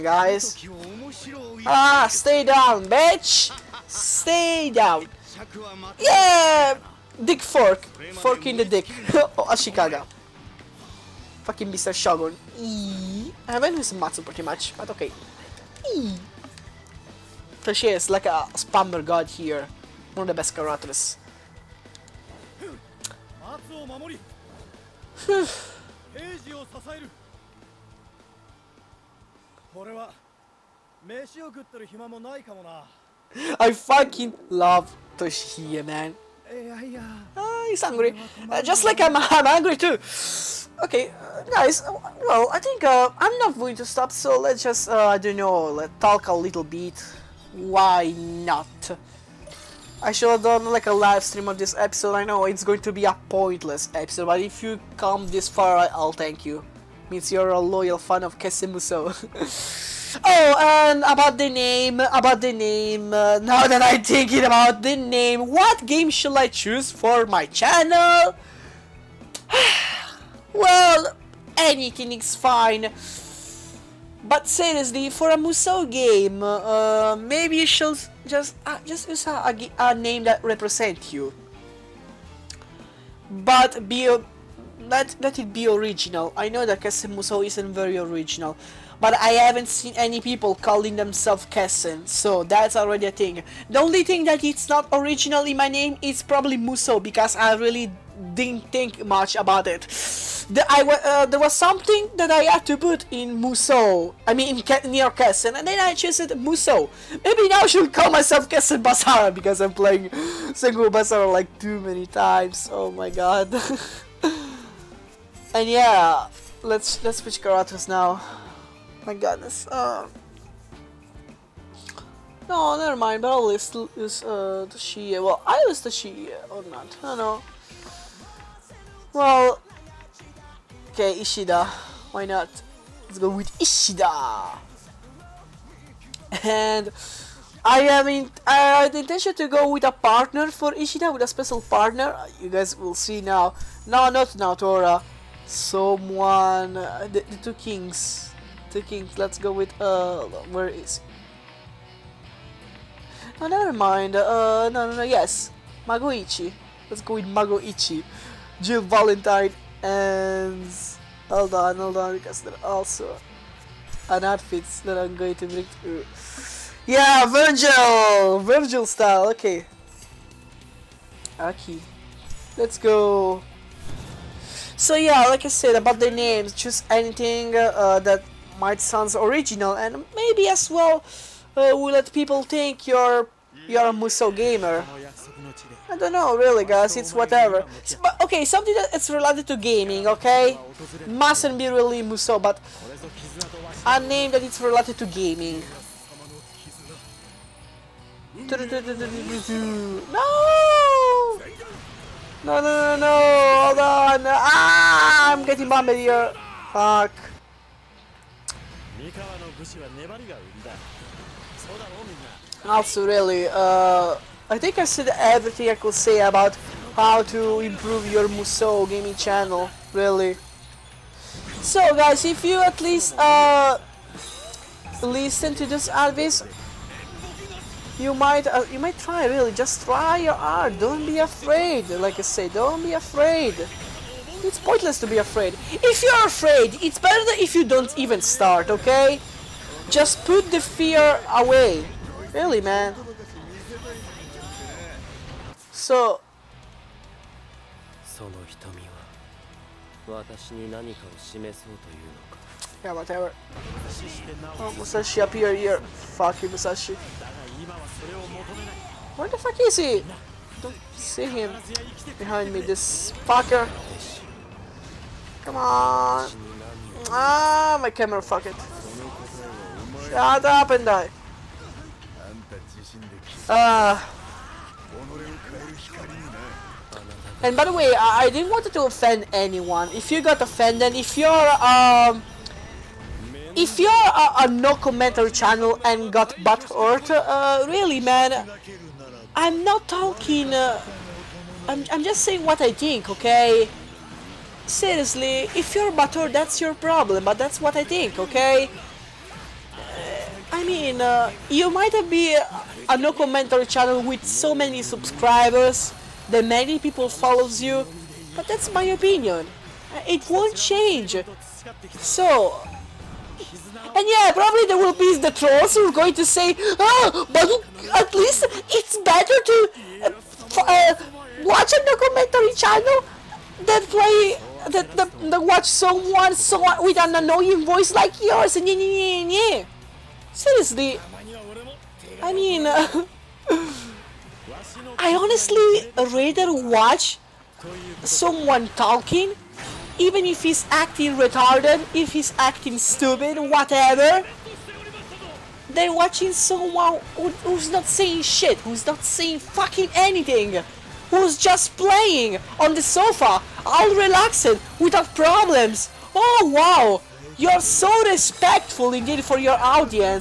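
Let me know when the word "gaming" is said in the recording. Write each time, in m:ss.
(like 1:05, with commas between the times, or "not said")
3:09, 3:15, 3:38.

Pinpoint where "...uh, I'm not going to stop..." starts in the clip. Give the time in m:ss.
0:42.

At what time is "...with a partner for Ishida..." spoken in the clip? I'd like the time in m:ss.
2:19.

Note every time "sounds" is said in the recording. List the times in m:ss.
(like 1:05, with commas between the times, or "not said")
2:58.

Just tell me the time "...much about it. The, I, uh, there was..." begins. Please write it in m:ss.
1:39.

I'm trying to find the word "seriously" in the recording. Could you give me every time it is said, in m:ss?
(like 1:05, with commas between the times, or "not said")
1:14, 4:54, 5:30.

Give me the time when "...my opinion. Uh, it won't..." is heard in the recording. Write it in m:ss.
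5:08.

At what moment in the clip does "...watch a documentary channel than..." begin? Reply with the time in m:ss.
5:21.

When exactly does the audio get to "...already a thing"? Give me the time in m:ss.
1:32.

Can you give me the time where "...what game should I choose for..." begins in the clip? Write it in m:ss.
1:05.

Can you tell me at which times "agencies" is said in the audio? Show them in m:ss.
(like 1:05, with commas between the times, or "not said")
not said.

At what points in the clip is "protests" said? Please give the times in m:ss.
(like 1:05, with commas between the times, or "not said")
not said.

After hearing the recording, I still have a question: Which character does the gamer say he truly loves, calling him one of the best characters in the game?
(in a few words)
Toshiie.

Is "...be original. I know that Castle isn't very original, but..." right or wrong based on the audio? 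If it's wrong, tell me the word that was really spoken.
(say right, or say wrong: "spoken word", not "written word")
right.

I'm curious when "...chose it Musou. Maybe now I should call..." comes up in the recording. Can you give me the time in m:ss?
1:45.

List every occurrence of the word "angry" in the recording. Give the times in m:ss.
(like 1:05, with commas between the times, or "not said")
0:39.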